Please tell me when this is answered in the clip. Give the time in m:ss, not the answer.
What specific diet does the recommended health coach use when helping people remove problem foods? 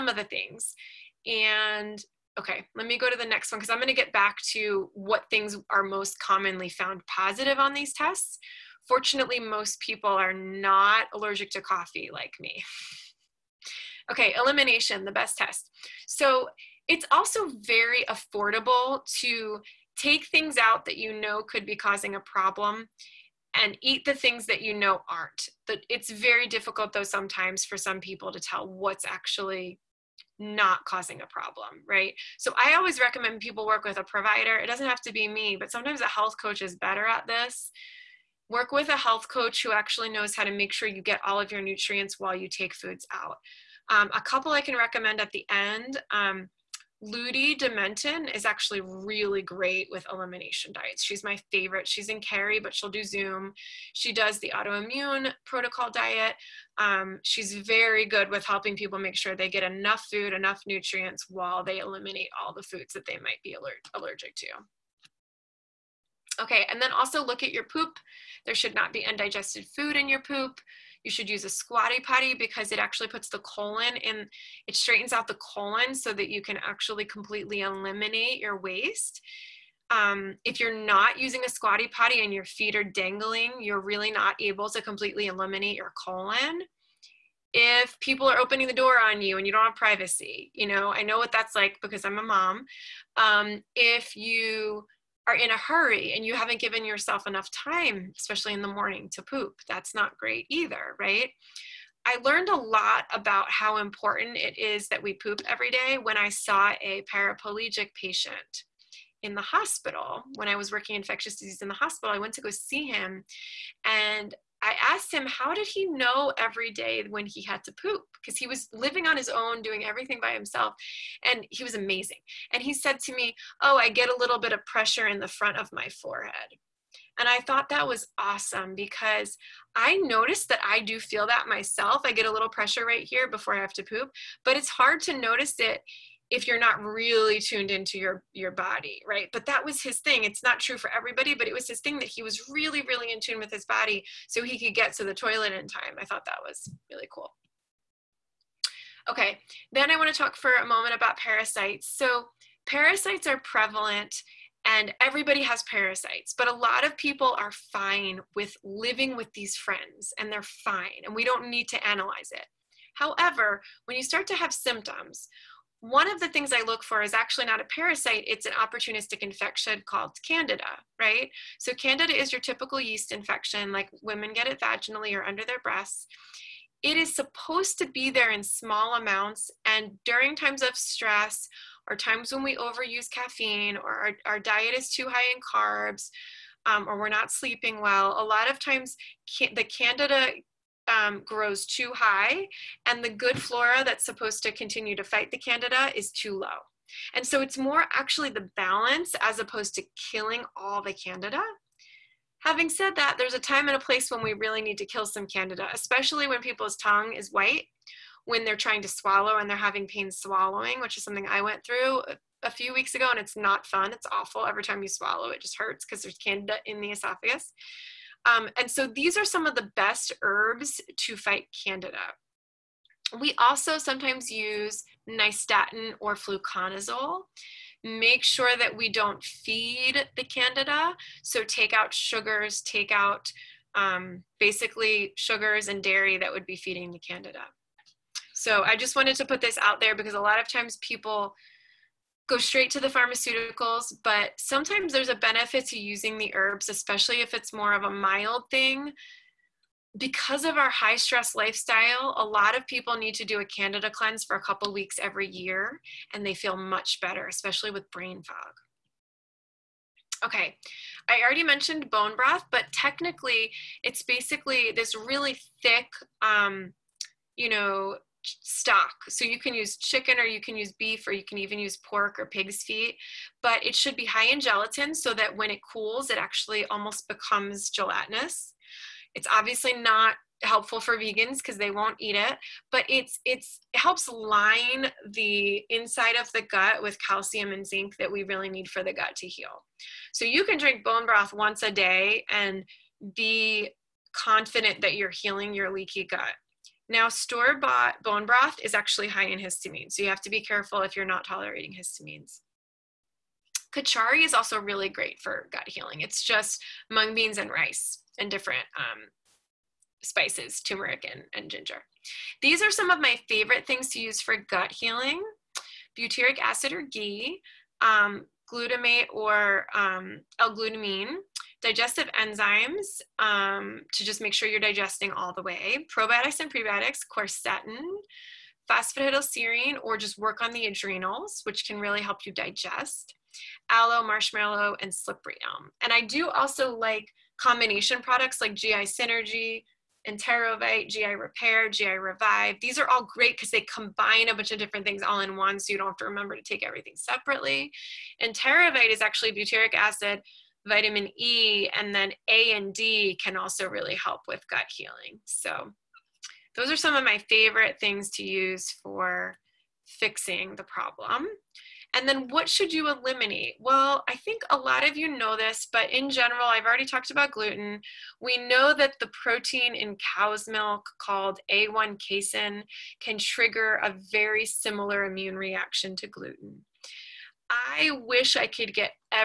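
0:54.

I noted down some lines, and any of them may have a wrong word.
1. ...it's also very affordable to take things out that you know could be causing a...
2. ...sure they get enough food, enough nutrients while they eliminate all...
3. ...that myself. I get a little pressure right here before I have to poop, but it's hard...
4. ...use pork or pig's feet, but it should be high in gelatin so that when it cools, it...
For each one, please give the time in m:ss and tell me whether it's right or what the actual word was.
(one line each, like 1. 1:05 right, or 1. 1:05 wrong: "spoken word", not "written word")
1. 0:16 right
2. 0:59 right
3. 2:11 right
4. 4:31 right.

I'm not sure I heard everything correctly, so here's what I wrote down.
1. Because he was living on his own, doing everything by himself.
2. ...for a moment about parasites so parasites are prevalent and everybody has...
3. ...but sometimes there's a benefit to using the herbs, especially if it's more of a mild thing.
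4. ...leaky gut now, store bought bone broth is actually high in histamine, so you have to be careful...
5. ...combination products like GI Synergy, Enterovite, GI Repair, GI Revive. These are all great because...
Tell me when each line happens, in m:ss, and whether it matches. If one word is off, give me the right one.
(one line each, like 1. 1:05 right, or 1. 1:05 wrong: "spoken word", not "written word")
1. 1:58 right
2. 2:30 right
3. 4:04 right
4. 4:55 right
5. 5:37 right.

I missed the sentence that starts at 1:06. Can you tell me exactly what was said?
Okay, and then also look at your poop.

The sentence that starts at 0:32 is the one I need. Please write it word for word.
So I always recommend people work with a provider.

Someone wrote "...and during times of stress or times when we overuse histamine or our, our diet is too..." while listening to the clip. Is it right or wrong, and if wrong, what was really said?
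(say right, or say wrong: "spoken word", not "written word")
wrong: "caffeine", not "histamine".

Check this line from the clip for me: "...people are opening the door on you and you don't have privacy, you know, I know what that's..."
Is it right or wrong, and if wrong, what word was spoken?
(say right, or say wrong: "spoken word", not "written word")
right.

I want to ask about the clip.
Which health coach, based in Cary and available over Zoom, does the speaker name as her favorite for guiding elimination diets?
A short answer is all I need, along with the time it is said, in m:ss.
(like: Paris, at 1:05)
Ludi Dementon, at 0:47.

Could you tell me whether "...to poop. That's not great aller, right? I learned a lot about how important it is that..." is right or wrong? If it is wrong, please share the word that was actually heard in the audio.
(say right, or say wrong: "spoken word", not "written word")
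wrong: "either", not "aller".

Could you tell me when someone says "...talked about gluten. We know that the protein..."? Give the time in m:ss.
6:06.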